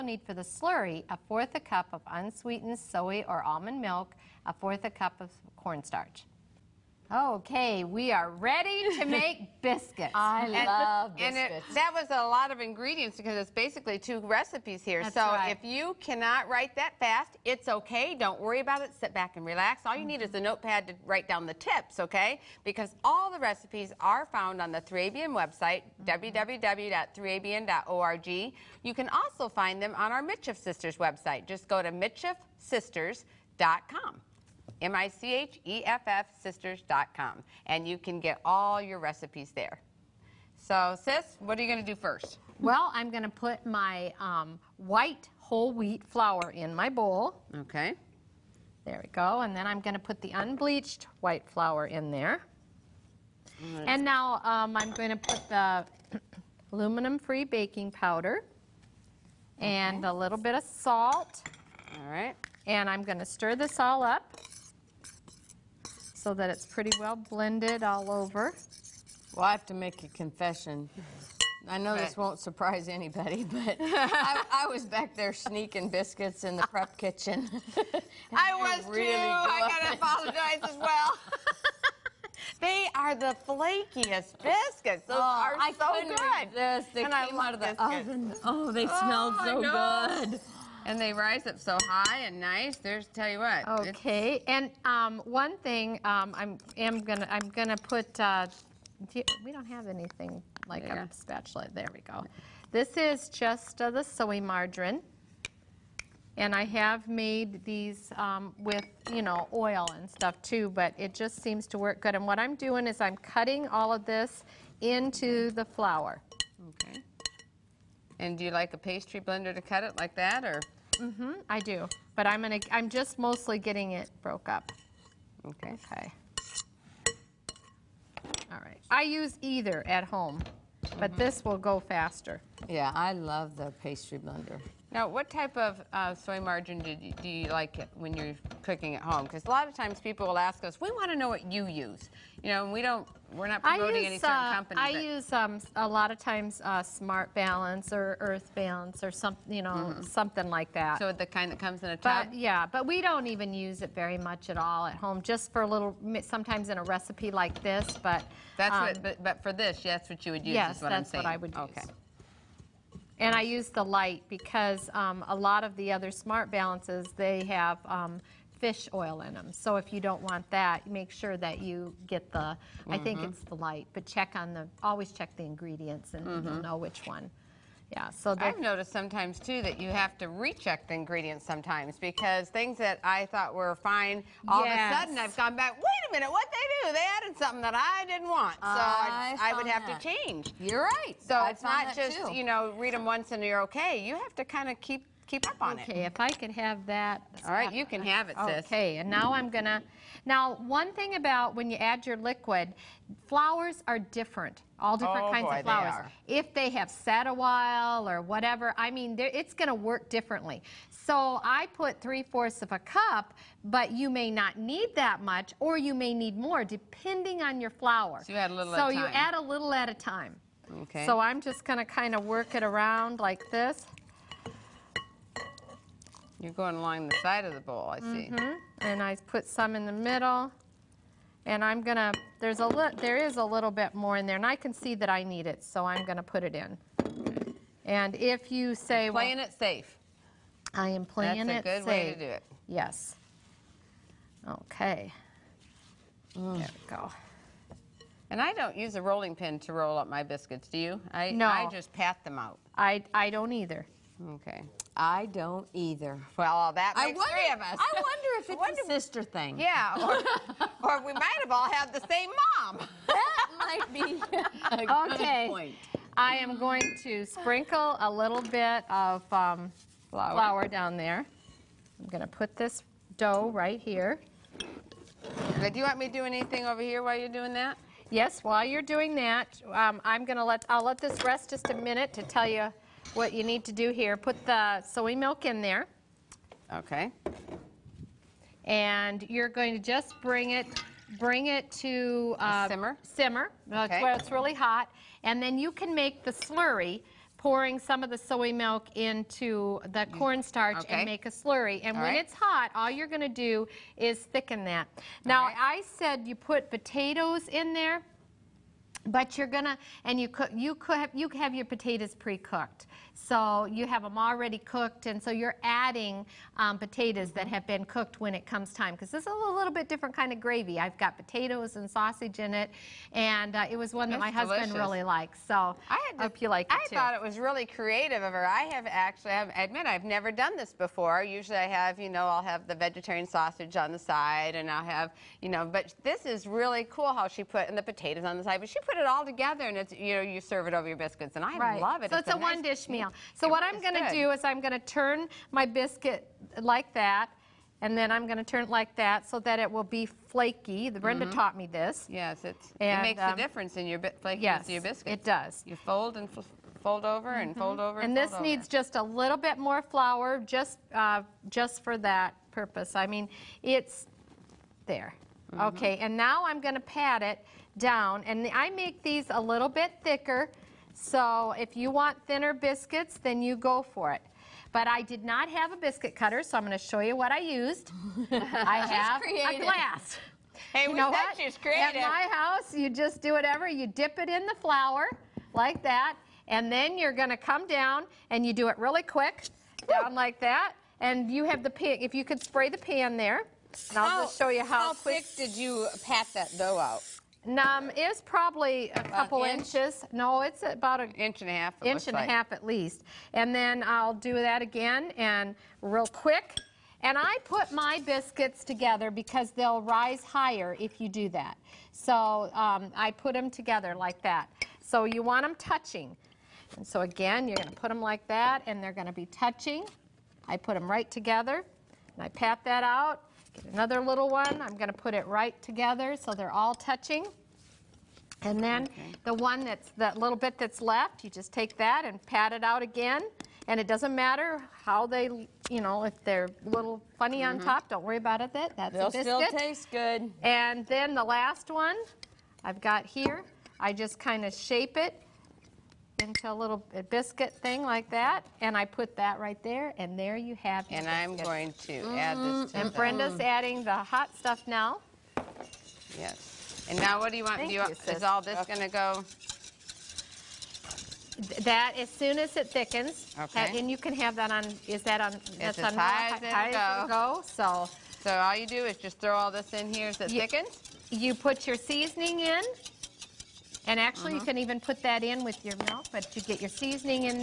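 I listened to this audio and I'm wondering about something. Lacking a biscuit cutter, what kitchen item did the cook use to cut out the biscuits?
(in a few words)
a glass.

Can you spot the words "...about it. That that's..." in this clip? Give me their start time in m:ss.
7:18.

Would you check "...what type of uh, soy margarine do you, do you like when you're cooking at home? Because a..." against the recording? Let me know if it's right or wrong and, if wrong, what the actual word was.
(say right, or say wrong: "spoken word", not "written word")
right.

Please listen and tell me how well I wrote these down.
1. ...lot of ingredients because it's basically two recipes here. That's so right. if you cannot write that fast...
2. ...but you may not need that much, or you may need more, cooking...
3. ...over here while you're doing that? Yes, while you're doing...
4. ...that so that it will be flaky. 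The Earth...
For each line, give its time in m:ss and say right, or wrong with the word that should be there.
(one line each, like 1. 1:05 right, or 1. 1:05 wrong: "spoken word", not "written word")
1. 0:12 right
2. 3:33 wrong: "depending", not "cooking"
3. 4:36 right
4. 5:48 wrong: "Brenda", not "Earth".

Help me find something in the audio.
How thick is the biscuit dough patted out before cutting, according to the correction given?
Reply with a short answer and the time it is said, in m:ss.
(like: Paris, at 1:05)
1.5 inches, at 6:40.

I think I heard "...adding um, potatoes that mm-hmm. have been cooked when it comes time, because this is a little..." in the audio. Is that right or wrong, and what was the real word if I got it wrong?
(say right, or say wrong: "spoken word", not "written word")
right.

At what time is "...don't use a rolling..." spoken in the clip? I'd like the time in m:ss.
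4:08.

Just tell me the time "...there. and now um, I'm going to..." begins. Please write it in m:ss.
0:52.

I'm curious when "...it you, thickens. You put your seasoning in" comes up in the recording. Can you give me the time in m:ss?
7:50.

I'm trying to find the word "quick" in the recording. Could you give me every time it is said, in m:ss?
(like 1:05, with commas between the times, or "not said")
6:29, 6:34, 6:46.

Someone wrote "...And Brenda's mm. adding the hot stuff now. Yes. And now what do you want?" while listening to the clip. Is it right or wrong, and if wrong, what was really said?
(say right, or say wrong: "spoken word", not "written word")
right.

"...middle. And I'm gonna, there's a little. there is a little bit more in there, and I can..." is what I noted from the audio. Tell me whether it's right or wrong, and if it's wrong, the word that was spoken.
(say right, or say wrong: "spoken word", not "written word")
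right.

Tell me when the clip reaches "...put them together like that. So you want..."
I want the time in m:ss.
6:53.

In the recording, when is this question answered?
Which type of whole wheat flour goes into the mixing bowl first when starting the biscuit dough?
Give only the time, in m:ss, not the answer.
0:44.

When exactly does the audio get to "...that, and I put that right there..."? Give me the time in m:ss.
7:28.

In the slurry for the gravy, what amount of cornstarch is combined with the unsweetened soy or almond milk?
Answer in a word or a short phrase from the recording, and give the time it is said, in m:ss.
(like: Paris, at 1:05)
1/4 cup, at 0:04.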